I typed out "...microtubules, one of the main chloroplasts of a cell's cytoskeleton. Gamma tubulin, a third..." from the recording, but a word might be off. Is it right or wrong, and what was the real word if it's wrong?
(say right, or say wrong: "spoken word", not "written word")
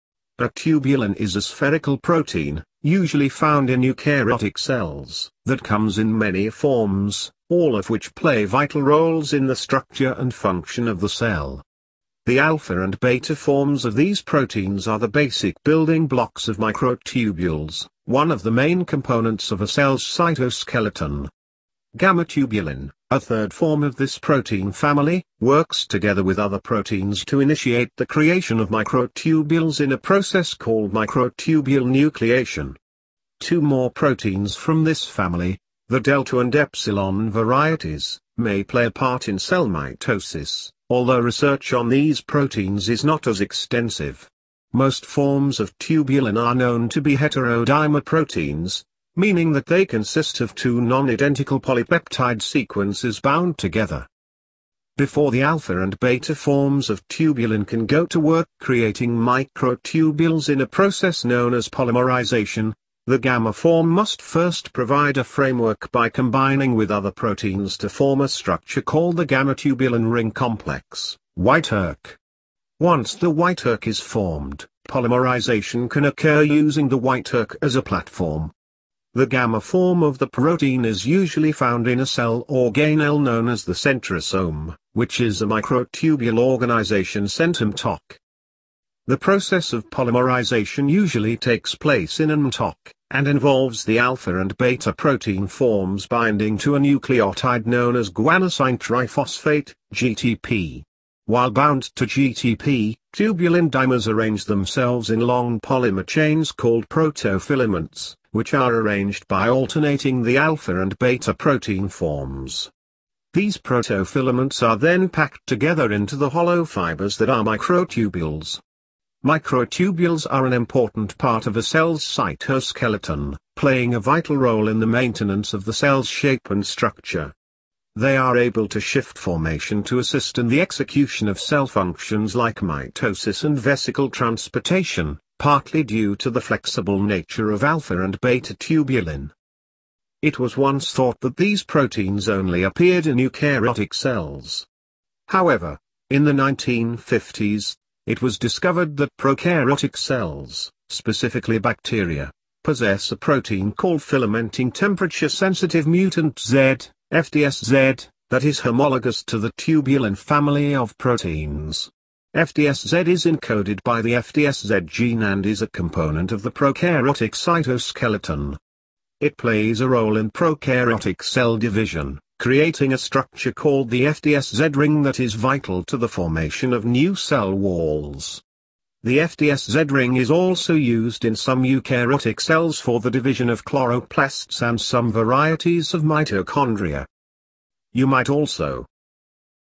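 wrong: "components", not "chloroplasts".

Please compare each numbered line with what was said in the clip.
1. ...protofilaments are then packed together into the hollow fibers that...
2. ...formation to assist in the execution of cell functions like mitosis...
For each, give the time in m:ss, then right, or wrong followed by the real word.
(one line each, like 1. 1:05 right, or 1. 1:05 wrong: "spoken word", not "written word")
1. 1:53 right
2. 2:09 right.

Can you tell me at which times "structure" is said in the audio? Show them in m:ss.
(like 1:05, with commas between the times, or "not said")
0:09, 1:08, 2:06, 2:52.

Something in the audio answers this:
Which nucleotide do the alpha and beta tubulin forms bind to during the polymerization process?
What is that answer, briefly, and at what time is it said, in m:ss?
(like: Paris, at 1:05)
guanosine triphosphate, at 1:38.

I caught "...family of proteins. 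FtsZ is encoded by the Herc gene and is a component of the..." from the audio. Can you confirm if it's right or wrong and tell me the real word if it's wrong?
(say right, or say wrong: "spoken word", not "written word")
wrong: "FtsZ", not "Herc".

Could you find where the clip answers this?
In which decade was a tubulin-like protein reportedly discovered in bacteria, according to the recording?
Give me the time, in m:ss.
2:26.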